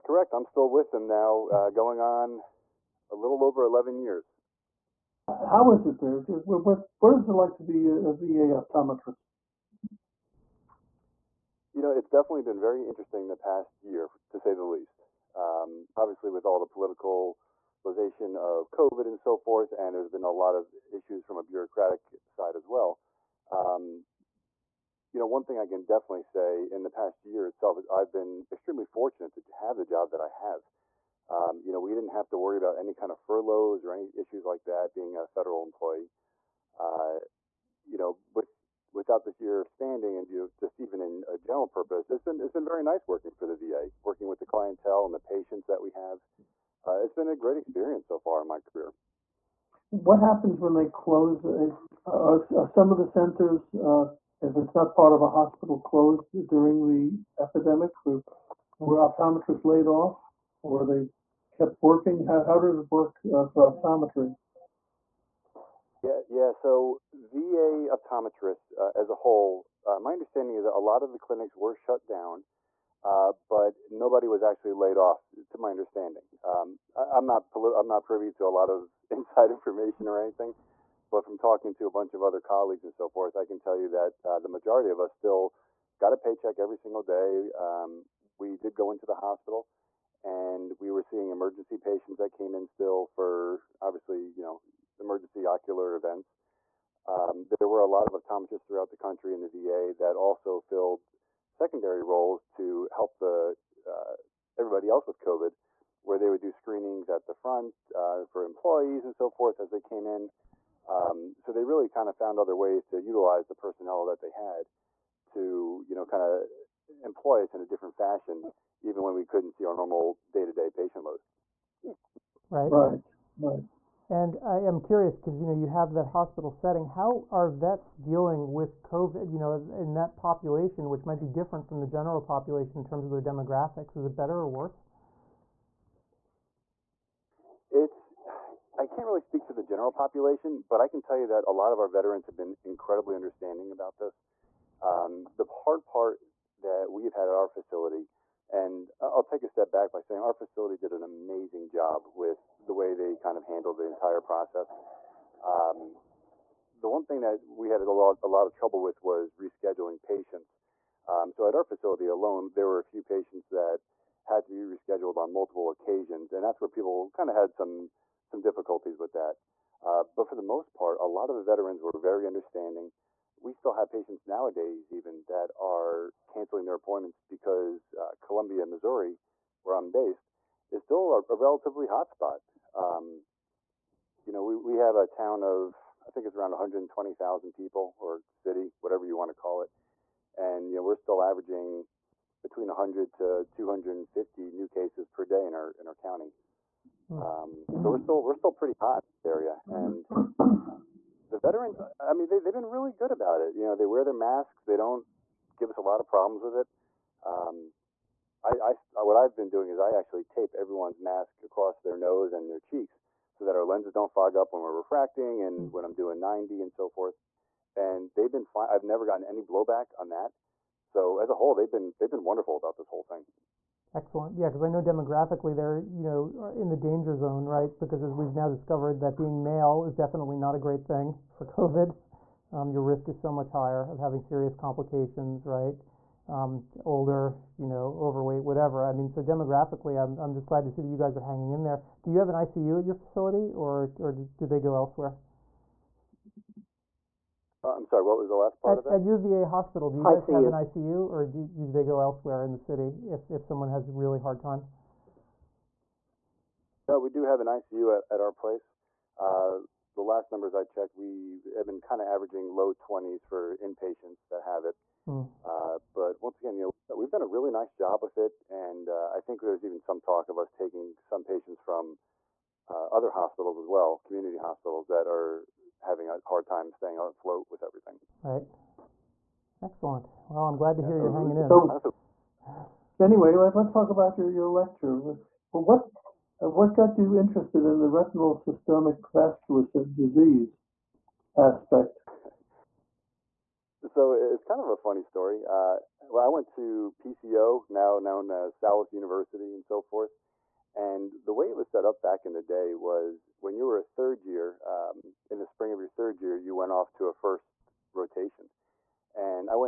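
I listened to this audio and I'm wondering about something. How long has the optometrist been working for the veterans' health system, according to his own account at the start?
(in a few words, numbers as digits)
a little over 11 years.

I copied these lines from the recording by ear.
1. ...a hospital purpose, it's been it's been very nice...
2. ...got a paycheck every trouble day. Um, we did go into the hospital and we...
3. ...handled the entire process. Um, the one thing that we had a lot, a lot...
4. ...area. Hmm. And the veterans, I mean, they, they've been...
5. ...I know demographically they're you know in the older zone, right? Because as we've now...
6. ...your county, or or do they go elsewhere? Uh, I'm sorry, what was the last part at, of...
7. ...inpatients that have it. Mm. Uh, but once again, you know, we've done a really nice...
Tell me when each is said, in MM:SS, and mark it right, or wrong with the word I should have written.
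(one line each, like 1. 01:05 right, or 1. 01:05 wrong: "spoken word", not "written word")
1. 00:41 wrong: "general", not "hospital"
2. 01:25 wrong: "single", not "trouble"
3. 02:33 right
4. 03:19 right
5. 03:44 wrong: "danger", not "older"
6. 04:02 wrong: "facility", not "county"
7. 04:23 right.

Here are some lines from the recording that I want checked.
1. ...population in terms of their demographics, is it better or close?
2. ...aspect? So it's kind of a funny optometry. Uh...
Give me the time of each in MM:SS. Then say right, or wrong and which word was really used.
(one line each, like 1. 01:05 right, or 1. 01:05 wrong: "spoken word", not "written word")
1. 02:12 wrong: "worse", not "close"
2. 04:51 wrong: "story", not "optometry".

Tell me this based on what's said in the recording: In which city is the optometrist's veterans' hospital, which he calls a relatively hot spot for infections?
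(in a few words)
Columbia, Missouri.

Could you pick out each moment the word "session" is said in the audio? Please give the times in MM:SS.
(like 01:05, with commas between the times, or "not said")
not said.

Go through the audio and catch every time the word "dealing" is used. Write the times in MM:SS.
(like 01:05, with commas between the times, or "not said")
02:07.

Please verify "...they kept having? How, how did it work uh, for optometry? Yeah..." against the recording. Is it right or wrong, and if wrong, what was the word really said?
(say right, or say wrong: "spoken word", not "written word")
wrong: "working", not "having".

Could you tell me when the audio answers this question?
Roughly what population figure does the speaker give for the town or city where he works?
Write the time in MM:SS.
03:06.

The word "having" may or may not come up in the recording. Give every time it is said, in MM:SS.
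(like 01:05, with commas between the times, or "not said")
03:53, 04:35.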